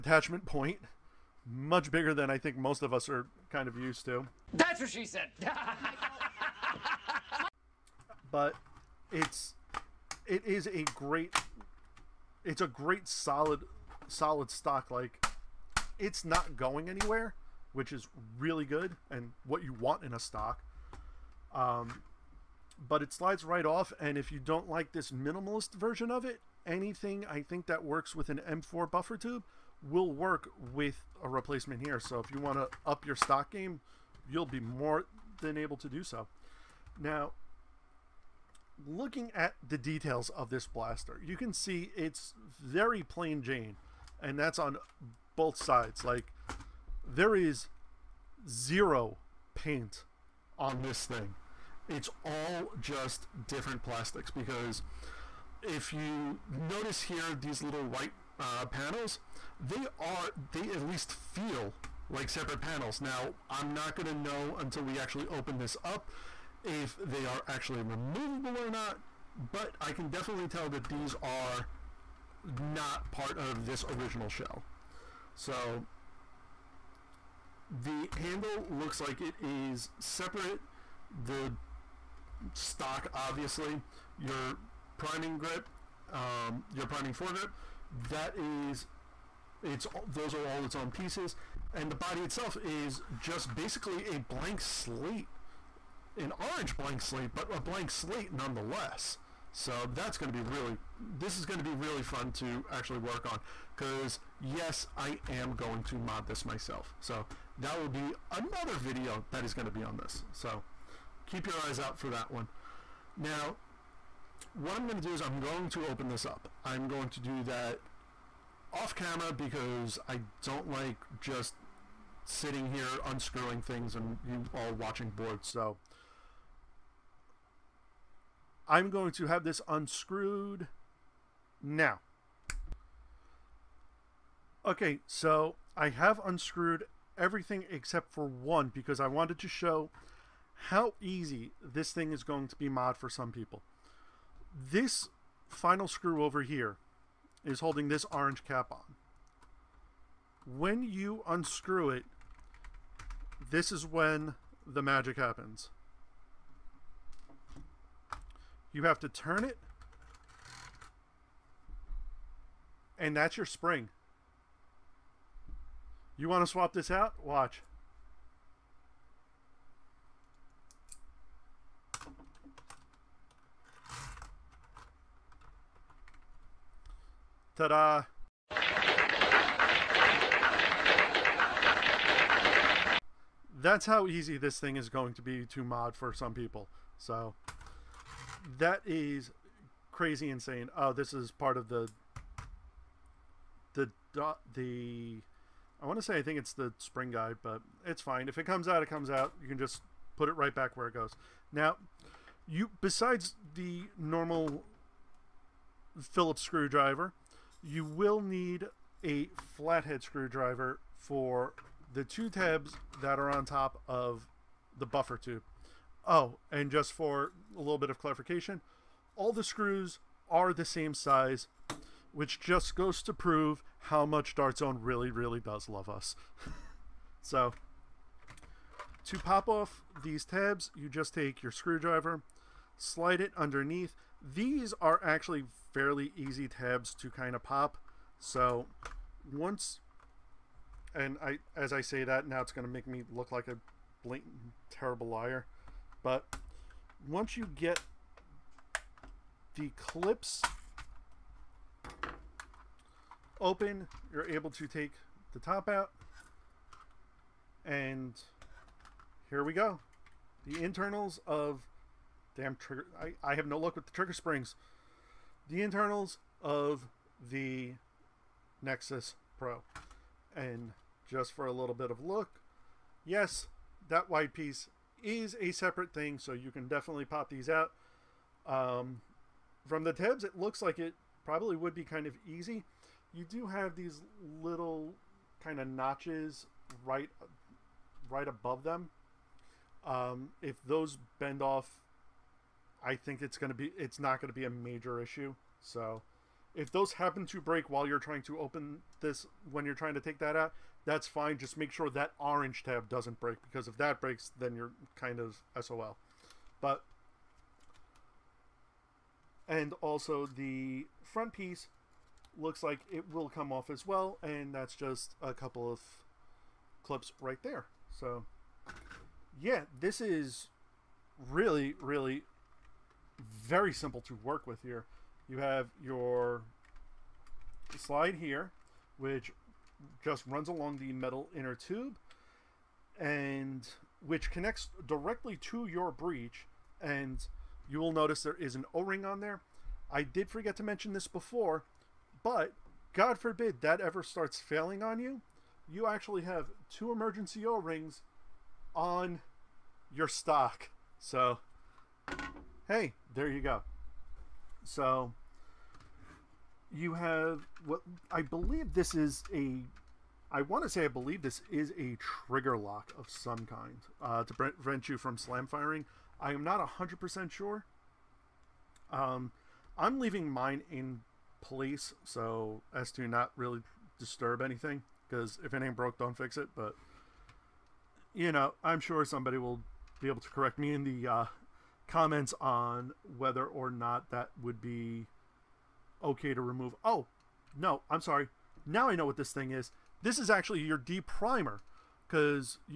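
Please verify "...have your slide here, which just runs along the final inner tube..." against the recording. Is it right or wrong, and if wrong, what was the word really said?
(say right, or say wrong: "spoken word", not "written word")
wrong: "metal", not "final".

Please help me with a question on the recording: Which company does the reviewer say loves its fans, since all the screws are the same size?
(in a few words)
Dartzone.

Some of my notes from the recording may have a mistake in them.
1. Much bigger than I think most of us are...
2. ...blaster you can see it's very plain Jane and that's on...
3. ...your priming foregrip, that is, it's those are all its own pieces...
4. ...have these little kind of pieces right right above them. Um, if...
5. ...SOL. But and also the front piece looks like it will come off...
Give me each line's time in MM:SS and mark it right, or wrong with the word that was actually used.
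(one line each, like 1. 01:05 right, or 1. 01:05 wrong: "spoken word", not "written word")
1. 00:01 right
2. 00:40 right
3. 01:26 right
4. 04:43 wrong: "notches", not "pieces"
5. 05:05 right.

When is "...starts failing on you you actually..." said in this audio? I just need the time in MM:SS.
05:44.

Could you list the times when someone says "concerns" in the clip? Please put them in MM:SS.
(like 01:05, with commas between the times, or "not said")
not said.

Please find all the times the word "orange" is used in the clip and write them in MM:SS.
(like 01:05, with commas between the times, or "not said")
01:36, 02:28, 05:02.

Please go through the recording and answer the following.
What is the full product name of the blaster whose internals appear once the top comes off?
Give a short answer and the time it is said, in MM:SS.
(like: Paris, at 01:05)
Nexus Pro, at 04:28.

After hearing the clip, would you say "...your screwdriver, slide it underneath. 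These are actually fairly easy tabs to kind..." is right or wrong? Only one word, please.
right.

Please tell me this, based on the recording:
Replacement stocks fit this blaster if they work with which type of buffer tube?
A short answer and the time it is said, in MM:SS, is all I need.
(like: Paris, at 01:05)
M4, at 00:28.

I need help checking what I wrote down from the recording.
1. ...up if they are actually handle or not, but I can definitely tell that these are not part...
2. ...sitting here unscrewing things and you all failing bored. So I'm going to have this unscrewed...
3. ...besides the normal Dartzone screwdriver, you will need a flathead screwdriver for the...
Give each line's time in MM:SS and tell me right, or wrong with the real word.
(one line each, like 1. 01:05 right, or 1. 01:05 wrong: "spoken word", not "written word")
1. 01:05 wrong: "removable", not "handle"
2. 02:02 wrong: "watching", not "failing"
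3. 03:22 wrong: "Phillips", not "Dartzone".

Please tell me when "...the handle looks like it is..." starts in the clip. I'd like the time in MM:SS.
01:17.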